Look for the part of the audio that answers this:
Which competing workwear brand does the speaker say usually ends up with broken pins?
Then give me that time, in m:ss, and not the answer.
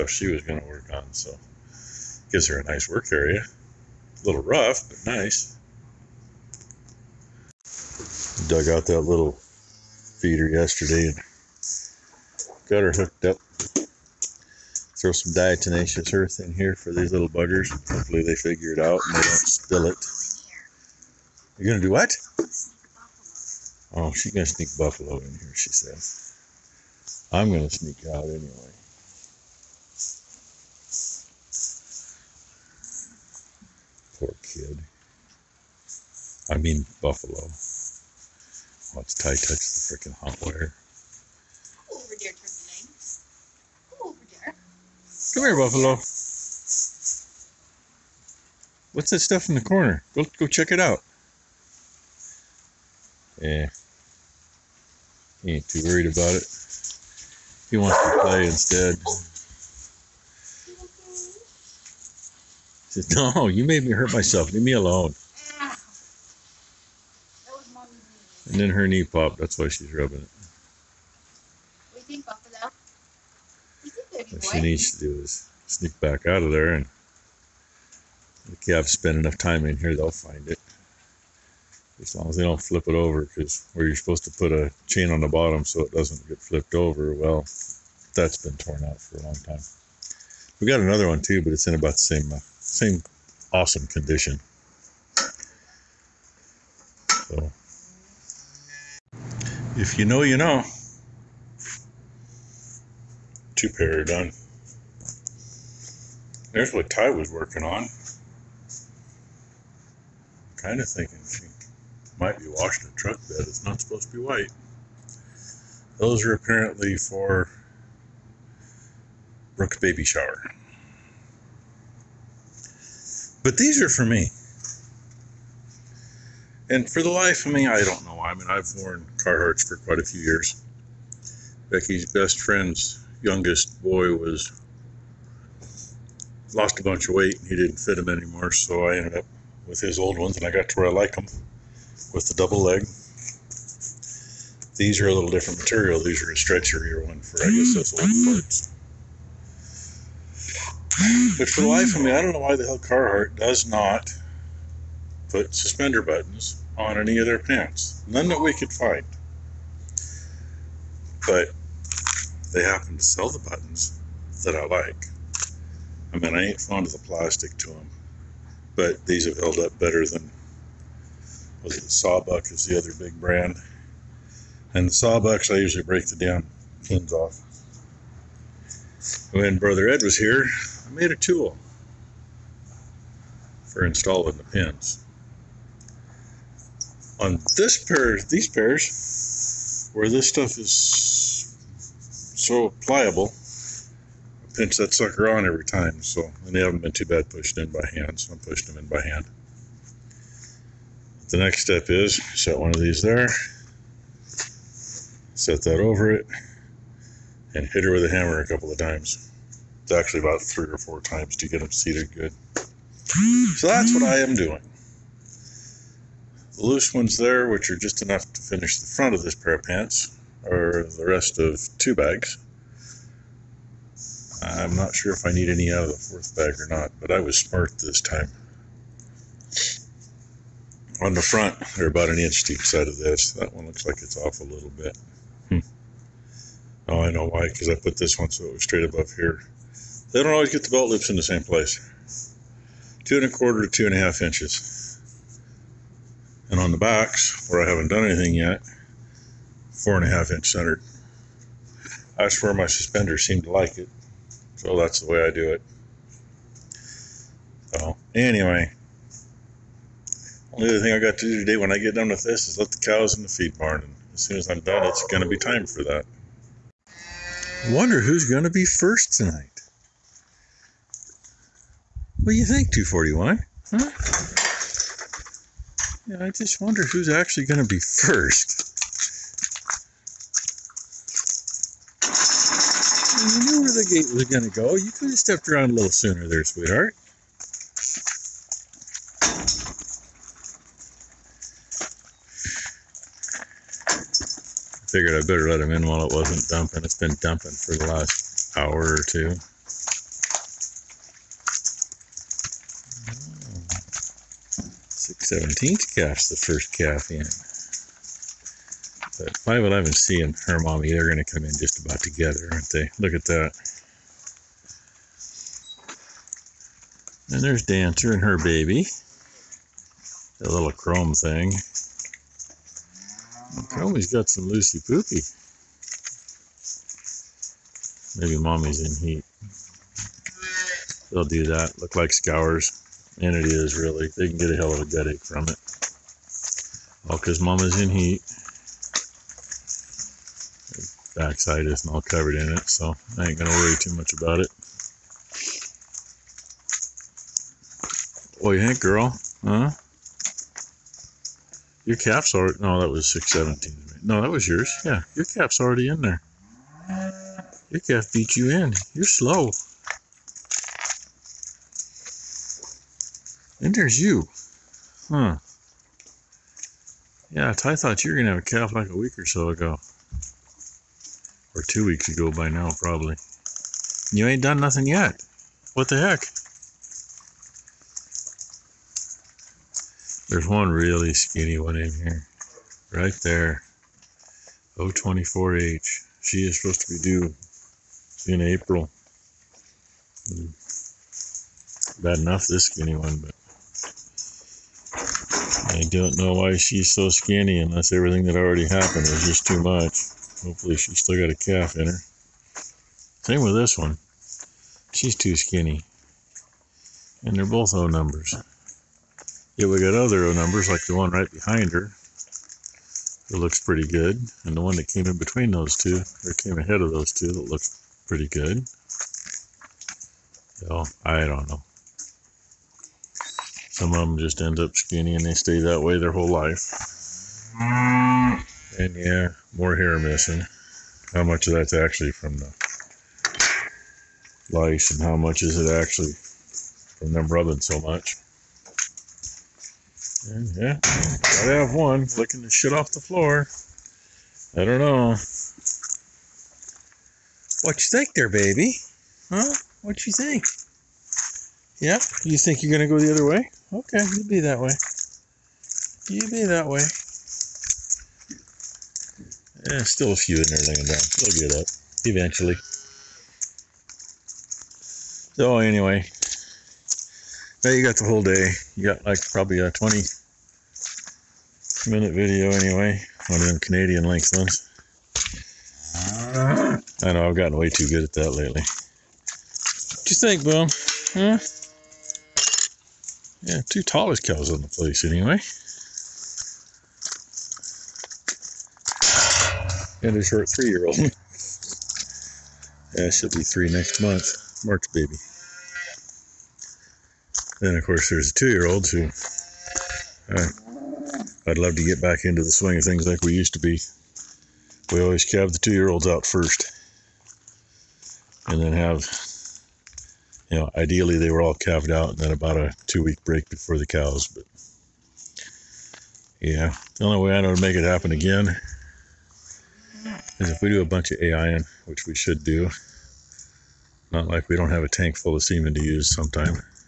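2:51.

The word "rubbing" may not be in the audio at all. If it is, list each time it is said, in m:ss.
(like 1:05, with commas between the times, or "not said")
1:09, 7:17.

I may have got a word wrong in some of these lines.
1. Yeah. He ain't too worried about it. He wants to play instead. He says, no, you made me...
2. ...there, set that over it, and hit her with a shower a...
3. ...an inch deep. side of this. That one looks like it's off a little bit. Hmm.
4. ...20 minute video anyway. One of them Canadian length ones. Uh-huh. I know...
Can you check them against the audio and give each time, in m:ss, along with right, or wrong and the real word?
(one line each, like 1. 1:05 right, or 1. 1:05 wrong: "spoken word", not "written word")
1. 0:53 right
2. 3:23 wrong: "hammer", not "shower"
3. 3:52 right
4. 7:49 right.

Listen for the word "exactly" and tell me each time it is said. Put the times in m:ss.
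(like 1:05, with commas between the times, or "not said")
not said.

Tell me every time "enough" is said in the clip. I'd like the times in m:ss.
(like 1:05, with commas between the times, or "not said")
1:19, 3:38, 6:32.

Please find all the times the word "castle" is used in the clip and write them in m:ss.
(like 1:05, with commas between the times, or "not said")
not said.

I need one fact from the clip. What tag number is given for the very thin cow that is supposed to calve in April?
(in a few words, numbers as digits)
024H.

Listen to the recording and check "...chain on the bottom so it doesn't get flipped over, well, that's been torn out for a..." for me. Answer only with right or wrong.
right.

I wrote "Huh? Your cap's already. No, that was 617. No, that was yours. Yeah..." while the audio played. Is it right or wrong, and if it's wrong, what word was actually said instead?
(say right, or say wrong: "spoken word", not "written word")
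right.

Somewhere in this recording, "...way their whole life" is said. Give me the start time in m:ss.
7:05.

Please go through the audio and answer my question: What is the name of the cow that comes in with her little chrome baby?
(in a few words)
Dancer.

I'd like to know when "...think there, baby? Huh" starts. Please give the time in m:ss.
7:27.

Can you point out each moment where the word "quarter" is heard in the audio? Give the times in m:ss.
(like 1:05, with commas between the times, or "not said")
4:03.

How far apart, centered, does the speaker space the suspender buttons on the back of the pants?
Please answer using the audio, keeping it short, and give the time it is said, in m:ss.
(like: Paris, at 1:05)
4.5 inches, at 4:09.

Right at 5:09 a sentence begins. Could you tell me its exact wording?
But 511C and her mommy, they're going to come in just about together, aren't they?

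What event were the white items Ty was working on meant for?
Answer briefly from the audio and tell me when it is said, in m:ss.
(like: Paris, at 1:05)
Brooke's baby shower, at 1:59.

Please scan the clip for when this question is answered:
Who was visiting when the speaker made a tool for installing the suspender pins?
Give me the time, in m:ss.
2:59.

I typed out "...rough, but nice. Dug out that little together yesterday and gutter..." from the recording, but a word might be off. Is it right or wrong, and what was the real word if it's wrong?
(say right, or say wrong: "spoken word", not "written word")
wrong: "feeder", not "together".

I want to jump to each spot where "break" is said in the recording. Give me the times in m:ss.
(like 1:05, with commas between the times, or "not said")
2:55, 8:33.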